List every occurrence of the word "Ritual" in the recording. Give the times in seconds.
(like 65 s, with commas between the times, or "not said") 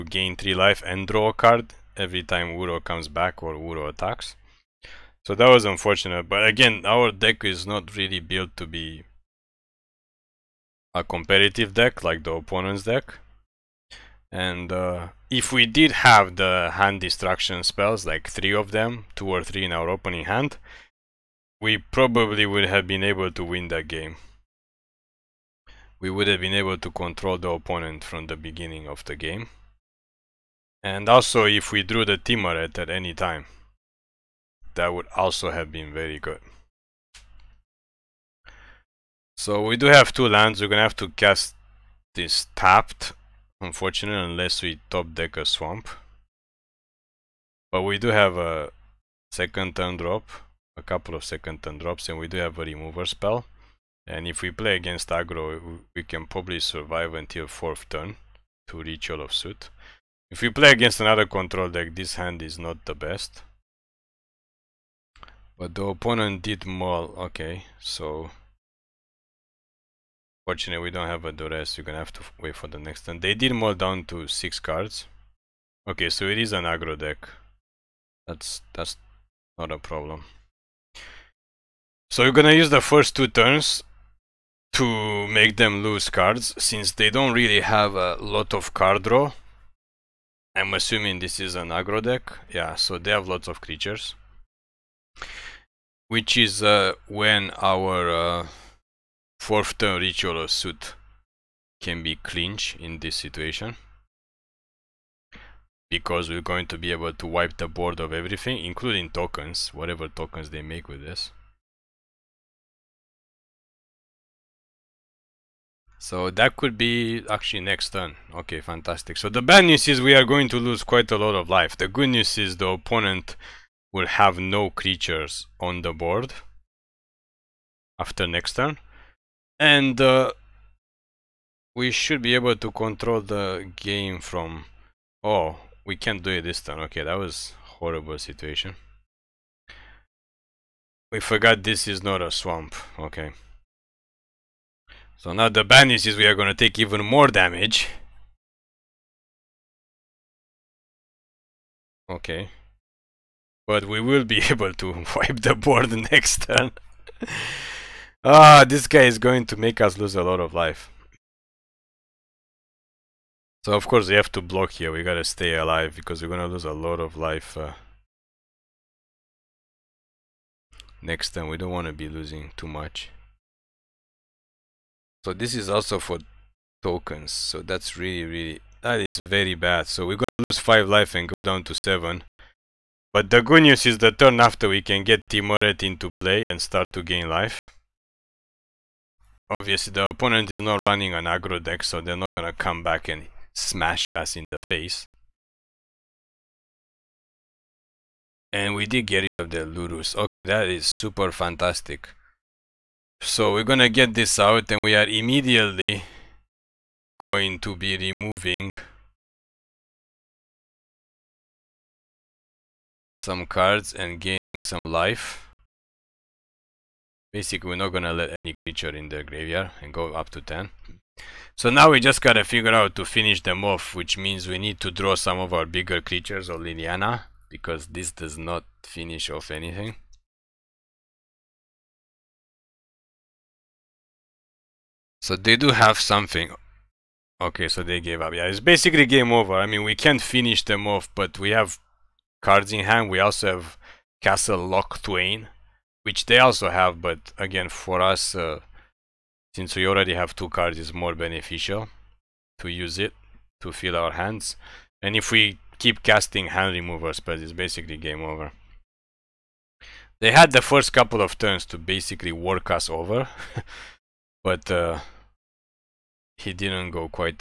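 58 s, 100 s.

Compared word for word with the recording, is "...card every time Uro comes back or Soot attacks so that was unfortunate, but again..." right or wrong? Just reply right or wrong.
wrong.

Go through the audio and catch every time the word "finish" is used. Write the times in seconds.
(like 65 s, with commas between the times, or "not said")
223 s, 228 s, 240 s.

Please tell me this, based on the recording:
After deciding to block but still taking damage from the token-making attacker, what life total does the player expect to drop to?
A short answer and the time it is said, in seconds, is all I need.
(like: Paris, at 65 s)
7, at 181 s.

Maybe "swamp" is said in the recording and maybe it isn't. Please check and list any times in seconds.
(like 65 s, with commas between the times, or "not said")
45 s, 142 s.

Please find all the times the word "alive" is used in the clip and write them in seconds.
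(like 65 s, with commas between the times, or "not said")
165 s.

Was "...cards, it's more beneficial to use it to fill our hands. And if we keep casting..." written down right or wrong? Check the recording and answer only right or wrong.
right.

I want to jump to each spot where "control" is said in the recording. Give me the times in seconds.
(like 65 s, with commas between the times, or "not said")
26 s, 61 s, 132 s.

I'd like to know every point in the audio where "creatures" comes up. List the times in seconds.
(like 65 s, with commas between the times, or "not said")
93 s, 124 s, 218 s, 225 s.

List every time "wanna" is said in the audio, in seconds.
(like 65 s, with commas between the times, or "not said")
171 s.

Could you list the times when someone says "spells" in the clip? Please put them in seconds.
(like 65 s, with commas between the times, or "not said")
17 s, 53 s.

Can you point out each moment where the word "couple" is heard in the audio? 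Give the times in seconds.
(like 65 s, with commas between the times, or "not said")
50 s, 260 s.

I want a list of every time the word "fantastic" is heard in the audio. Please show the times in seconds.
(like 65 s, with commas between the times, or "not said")
118 s, 201 s.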